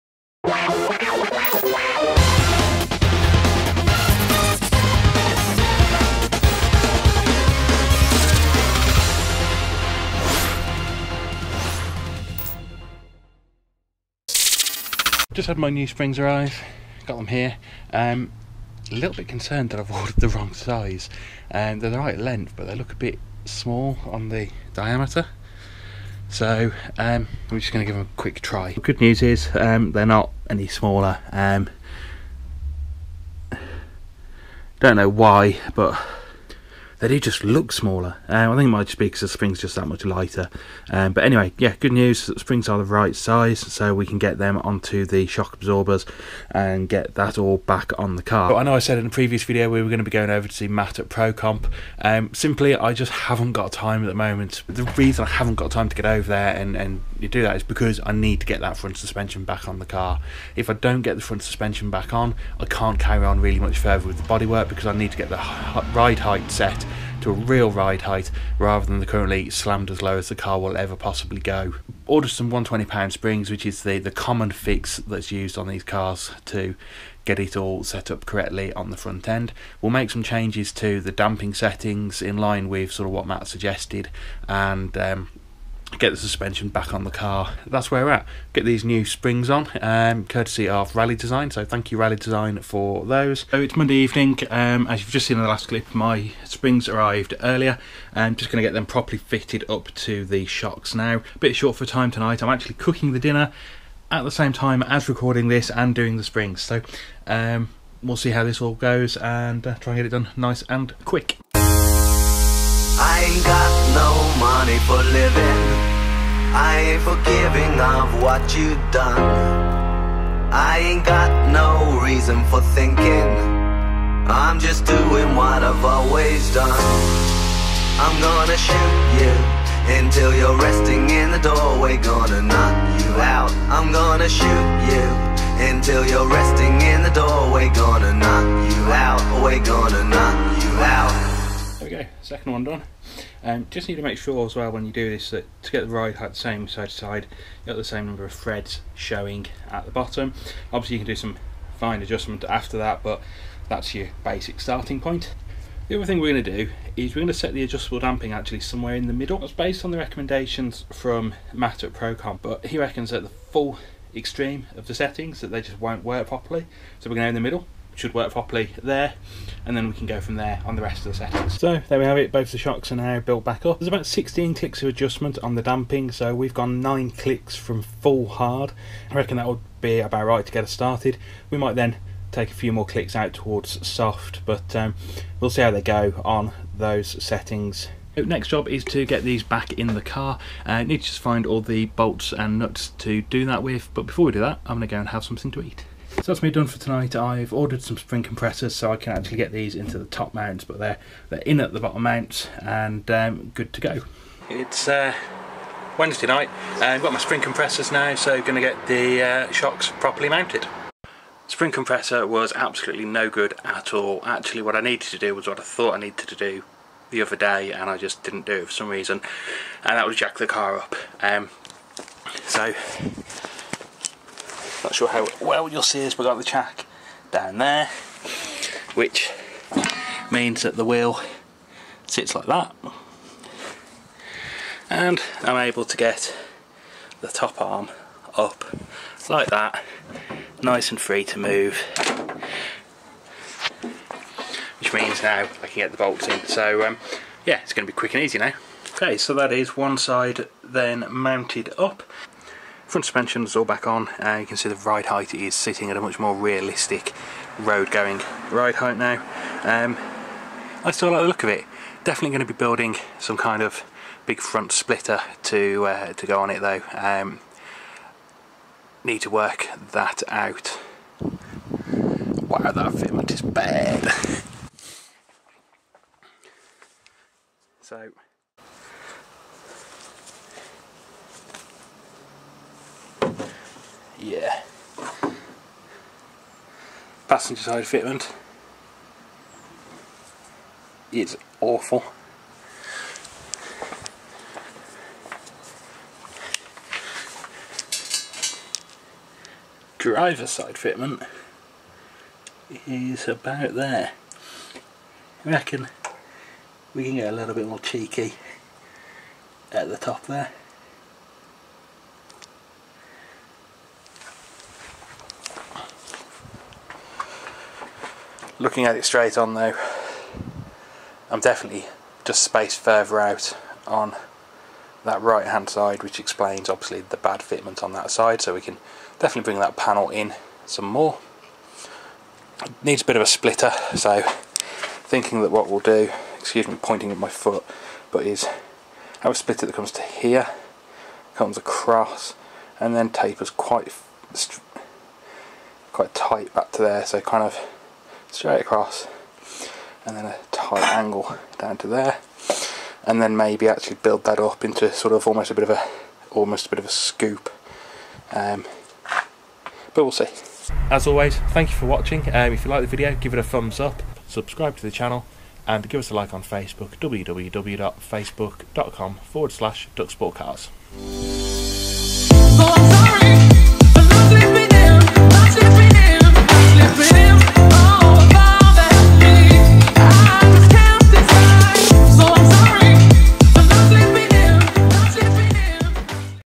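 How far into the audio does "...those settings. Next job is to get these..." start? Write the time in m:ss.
3:06.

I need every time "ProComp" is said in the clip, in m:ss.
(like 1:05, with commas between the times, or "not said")
0:51, 2:41.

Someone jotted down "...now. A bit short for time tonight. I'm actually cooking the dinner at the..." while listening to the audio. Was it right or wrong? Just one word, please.
right.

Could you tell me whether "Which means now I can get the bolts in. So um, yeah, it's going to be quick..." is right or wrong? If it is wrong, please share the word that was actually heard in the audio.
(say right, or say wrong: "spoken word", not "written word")
right.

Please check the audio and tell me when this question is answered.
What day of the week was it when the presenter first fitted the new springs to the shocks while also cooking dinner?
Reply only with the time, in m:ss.
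1:33.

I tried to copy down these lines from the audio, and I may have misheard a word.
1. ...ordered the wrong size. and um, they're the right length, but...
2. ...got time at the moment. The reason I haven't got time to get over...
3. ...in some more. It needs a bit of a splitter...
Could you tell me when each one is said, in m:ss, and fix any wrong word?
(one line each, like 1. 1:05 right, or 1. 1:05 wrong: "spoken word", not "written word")
1. 0:19 right
2. 0:53 right
3. 5:30 right.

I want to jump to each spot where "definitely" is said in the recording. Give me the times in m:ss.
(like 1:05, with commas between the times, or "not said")
4:22, 5:21, 5:29.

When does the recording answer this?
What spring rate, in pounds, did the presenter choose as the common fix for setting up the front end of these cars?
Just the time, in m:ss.
1:12.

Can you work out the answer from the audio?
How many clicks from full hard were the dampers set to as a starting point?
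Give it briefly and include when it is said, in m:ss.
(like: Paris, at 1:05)
9, at 2:56.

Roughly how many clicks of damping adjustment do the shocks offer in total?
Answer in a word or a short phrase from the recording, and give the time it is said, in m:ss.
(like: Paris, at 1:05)
16, at 2:54.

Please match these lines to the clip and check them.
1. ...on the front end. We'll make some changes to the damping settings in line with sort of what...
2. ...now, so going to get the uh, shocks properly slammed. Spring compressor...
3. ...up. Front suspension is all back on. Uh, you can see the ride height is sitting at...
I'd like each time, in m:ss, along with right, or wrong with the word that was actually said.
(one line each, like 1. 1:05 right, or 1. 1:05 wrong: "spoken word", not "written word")
1. 1:18 right
2. 3:27 wrong: "mounted", not "slammed"
3. 4:11 right.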